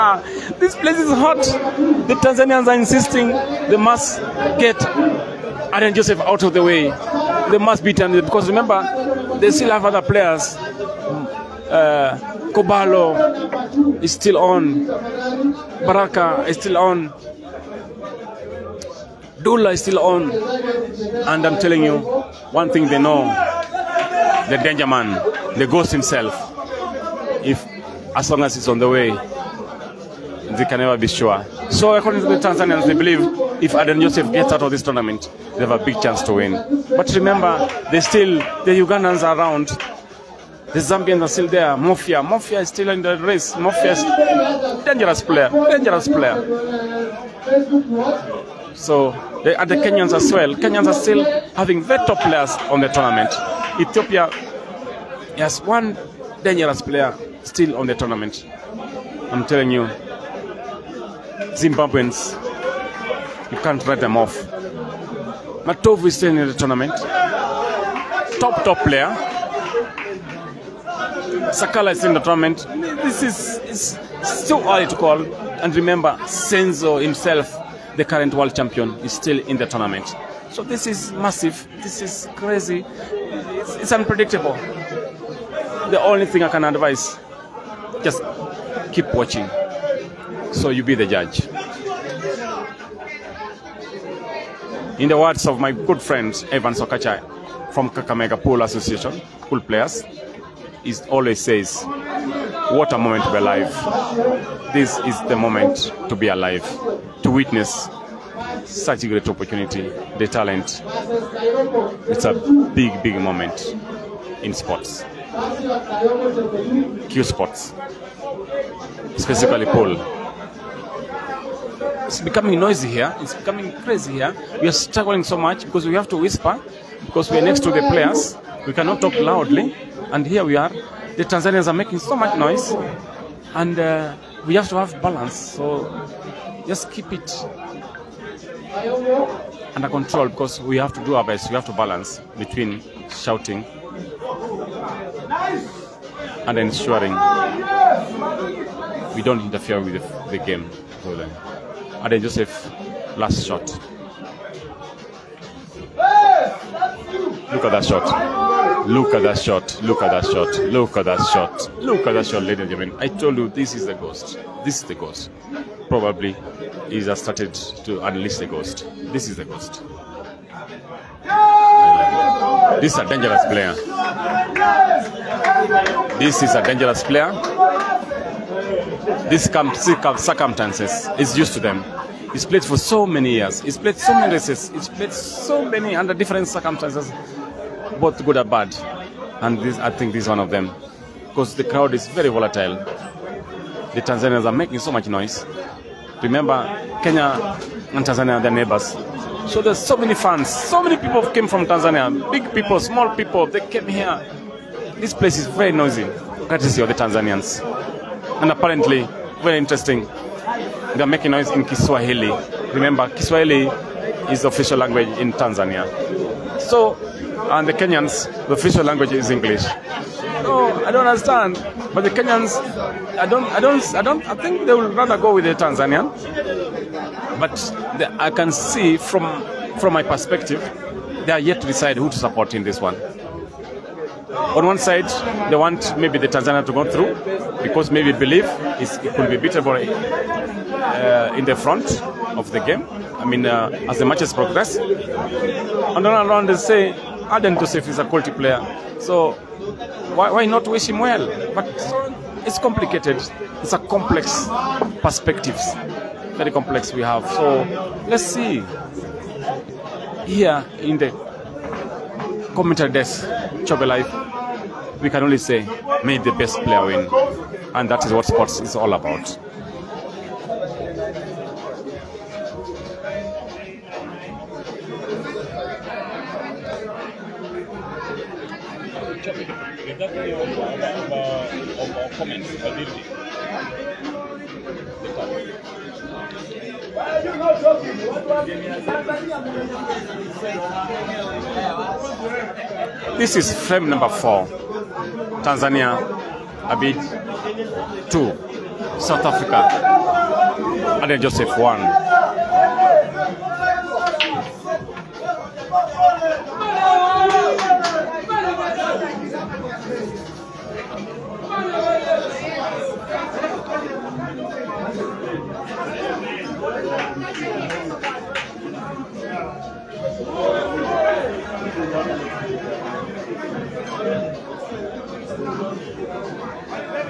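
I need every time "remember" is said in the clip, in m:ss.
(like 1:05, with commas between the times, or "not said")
0:08, 0:37, 1:15, 3:16, 3:32.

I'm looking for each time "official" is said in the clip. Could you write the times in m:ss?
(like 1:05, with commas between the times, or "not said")
3:34, 3:38.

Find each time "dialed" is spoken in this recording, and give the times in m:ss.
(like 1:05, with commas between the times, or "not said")
not said.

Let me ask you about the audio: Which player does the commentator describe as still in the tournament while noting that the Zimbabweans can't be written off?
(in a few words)
Matovu.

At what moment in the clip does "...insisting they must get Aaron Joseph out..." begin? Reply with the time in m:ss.
0:02.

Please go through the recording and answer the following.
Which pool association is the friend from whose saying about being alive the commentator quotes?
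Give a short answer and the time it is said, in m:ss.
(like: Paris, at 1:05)
Kakamega Pool Association, at 1:37.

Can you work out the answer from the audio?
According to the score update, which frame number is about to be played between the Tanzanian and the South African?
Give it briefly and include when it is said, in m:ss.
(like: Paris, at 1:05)
4, at 4:54.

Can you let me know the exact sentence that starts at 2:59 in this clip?
This circumstances is used to them.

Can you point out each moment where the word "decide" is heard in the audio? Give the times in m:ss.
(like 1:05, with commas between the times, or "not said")
3:51.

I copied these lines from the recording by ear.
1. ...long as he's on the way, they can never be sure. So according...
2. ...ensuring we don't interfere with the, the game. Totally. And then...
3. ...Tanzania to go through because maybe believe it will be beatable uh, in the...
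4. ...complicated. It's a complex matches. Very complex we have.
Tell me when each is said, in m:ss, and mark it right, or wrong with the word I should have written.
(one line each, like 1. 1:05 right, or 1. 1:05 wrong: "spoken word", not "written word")
1. 0:28 right
2. 2:26 right
3. 3:56 right
4. 4:12 wrong: "perspectives", not "matches".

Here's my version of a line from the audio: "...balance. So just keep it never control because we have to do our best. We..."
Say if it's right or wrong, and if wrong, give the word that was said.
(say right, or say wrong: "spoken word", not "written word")
wrong: "under", not "never".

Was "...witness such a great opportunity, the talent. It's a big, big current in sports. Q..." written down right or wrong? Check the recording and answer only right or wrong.
wrong.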